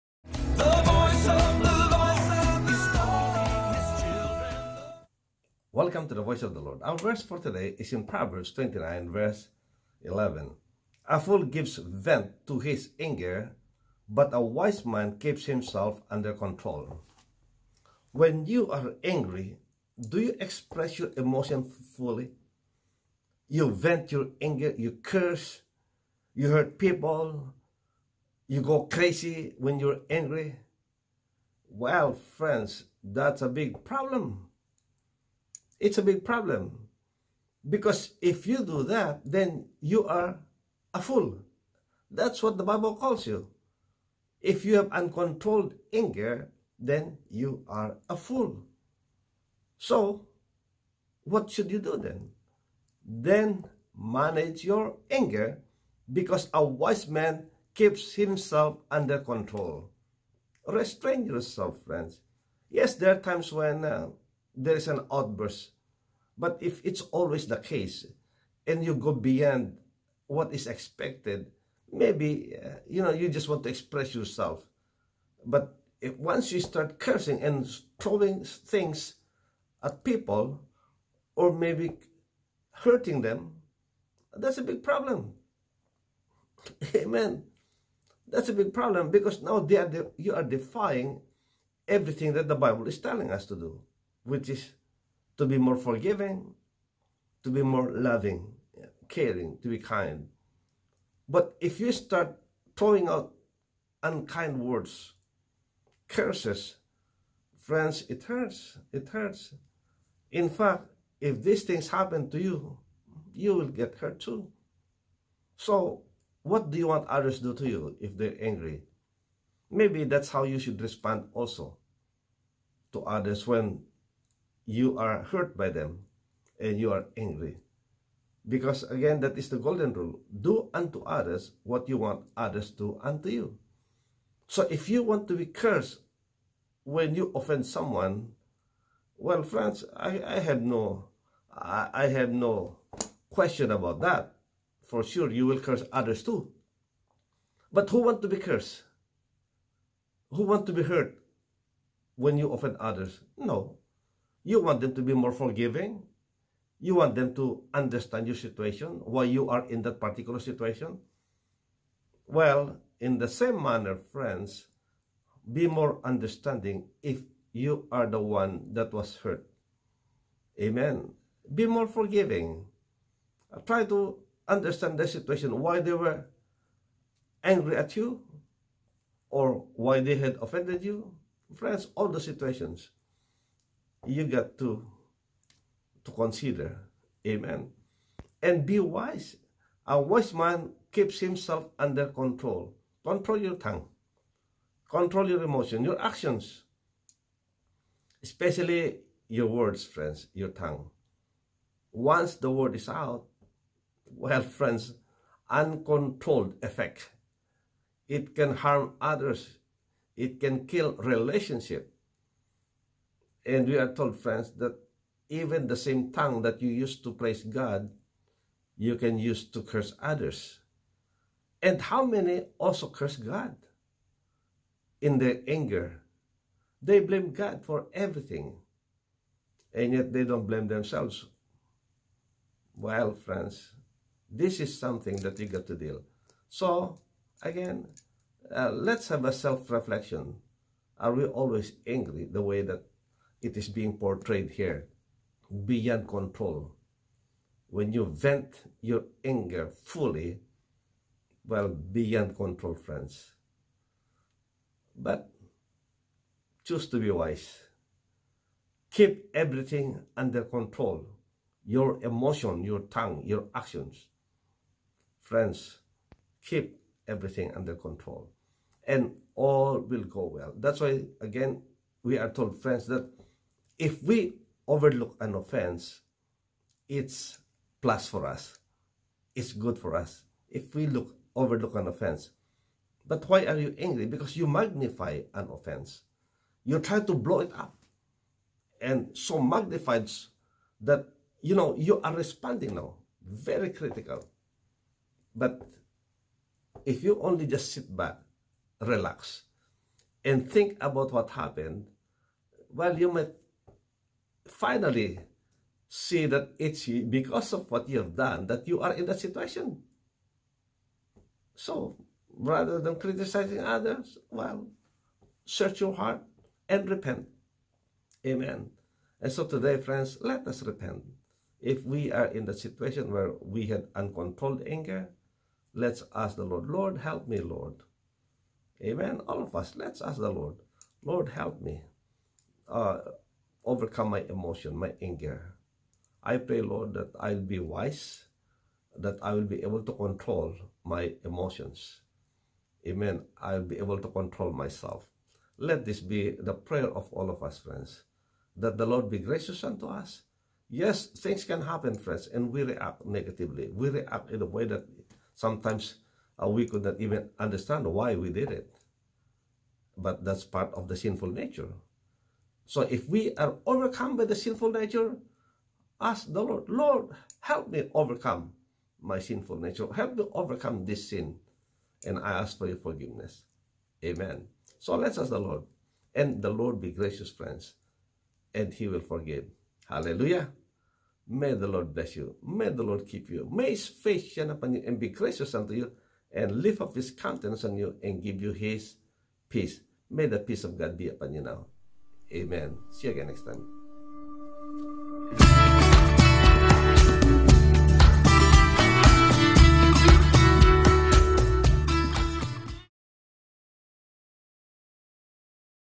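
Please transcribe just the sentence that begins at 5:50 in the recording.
Yes, things can happen, friends, and we react negatively.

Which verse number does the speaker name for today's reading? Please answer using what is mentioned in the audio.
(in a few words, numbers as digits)
11.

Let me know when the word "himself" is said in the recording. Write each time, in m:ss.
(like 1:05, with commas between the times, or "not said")
0:15, 0:58, 3:11.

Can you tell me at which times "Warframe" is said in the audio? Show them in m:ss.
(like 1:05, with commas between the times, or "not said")
not said.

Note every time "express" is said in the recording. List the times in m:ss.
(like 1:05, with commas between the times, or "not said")
0:20, 1:13.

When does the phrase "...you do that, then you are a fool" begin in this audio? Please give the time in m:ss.
0:38.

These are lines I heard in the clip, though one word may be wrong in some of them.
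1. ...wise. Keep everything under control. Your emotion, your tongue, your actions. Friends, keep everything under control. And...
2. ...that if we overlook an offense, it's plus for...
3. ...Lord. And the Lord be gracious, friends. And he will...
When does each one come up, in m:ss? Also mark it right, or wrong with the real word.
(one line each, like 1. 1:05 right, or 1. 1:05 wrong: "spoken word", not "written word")
1. 4:17 right
2. 4:32 right
3. 6:15 right.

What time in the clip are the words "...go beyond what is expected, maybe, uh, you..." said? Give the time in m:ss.
1:08.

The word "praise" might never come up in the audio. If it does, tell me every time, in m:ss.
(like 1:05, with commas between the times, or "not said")
3:37.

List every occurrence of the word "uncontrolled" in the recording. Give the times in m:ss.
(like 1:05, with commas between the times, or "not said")
0:44, 3:25, 5:23.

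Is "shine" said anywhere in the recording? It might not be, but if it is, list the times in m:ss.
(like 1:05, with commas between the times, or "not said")
6:24.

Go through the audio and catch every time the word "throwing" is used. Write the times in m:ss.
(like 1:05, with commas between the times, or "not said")
1:17, 1:42.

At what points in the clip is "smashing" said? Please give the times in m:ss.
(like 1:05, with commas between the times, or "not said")
not said.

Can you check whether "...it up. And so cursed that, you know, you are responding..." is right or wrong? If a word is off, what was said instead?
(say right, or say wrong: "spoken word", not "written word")
wrong: "magnified", not "cursed".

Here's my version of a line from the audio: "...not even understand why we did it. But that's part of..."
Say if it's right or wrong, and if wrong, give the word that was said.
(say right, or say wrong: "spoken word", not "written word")
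right.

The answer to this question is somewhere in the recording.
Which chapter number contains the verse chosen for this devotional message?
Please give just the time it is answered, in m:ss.
0:08.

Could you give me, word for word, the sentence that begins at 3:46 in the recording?
They blame God for everything, and yet they don't blame themselves.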